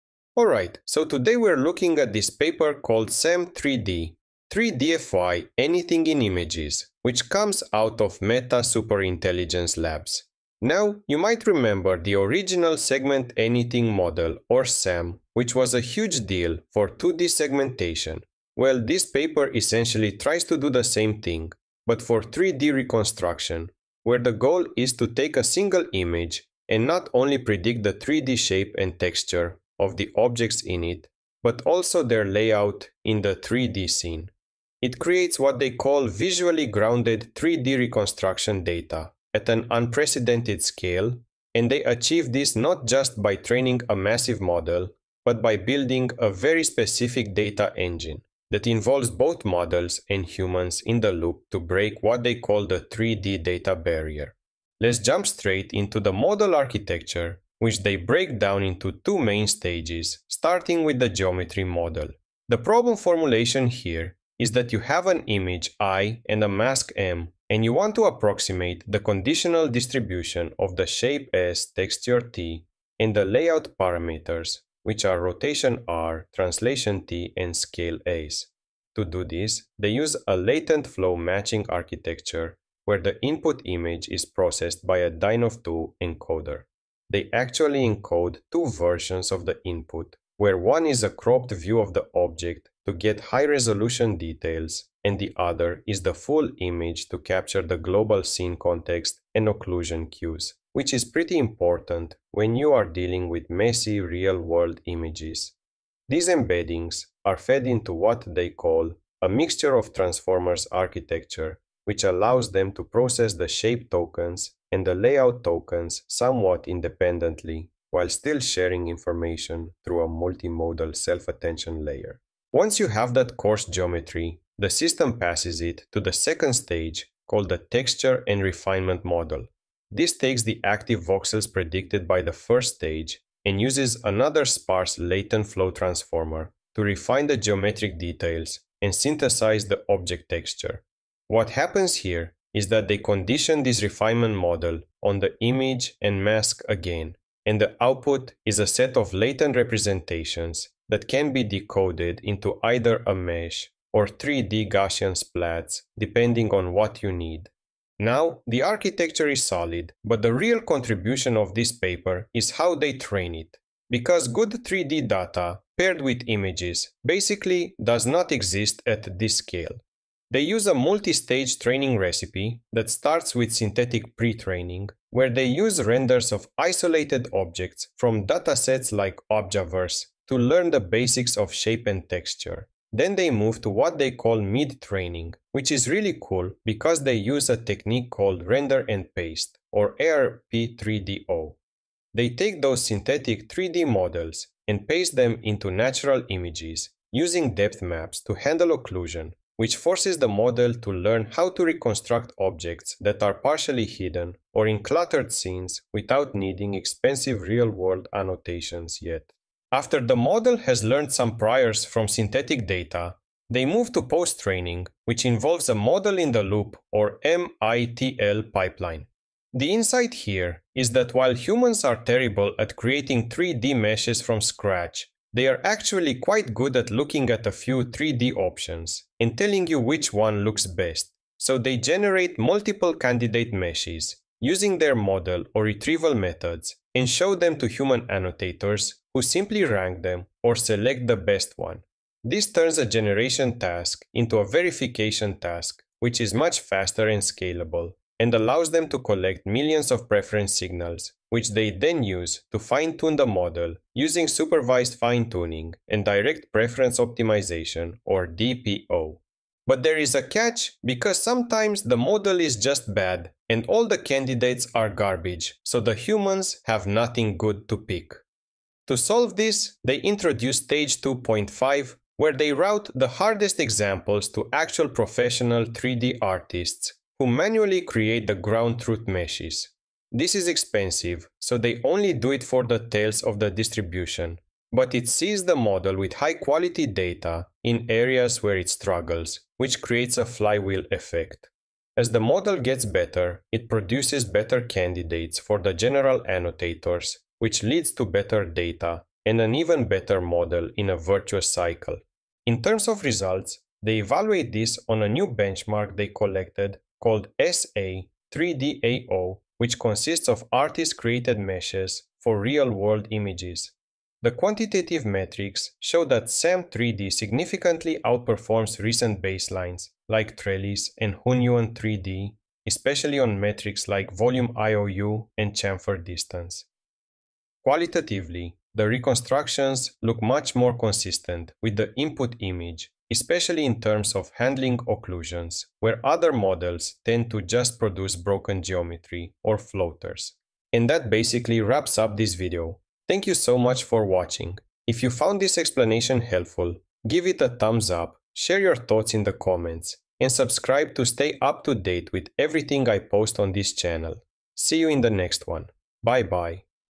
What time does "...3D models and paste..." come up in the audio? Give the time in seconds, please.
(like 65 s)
193 s.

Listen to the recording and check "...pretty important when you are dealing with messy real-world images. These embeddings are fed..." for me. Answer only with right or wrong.
right.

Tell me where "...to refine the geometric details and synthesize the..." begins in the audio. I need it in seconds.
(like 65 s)
136 s.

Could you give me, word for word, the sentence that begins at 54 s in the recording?
Let's jump straight into the model architecture which they break down into two main stages, starting with the geometry model.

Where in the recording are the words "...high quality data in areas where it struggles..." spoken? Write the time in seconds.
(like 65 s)
286 s.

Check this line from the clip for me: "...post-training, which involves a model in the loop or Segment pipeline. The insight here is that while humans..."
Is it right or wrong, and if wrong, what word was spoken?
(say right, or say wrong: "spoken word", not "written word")
wrong: "MITL", not "Segment".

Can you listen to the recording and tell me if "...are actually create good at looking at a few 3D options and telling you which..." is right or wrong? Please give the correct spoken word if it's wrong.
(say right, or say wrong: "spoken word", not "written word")
wrong: "quite", not "create".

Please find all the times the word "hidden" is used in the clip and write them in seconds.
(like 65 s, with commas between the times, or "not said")
203 s.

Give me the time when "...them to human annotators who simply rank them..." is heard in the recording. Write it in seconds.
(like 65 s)
237 s.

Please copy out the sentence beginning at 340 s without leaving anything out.
And that basically wraps up this video.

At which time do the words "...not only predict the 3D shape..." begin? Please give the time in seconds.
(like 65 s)
26 s.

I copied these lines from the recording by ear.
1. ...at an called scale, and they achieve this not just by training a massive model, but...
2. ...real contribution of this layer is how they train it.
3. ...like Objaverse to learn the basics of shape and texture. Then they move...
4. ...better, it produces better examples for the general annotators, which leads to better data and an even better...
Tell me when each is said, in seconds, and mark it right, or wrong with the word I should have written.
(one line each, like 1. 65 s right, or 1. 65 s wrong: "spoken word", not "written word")
1. 39 s wrong: "unprecedented", not "called"
2. 160 s wrong: "paper", not "layer"
3. 178 s right
4. 292 s wrong: "candidates", not "examples".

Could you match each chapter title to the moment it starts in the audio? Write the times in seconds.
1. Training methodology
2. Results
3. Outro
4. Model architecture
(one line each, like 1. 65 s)
1. 157 s
2. 302 s
3. 340 s
4. 54 s.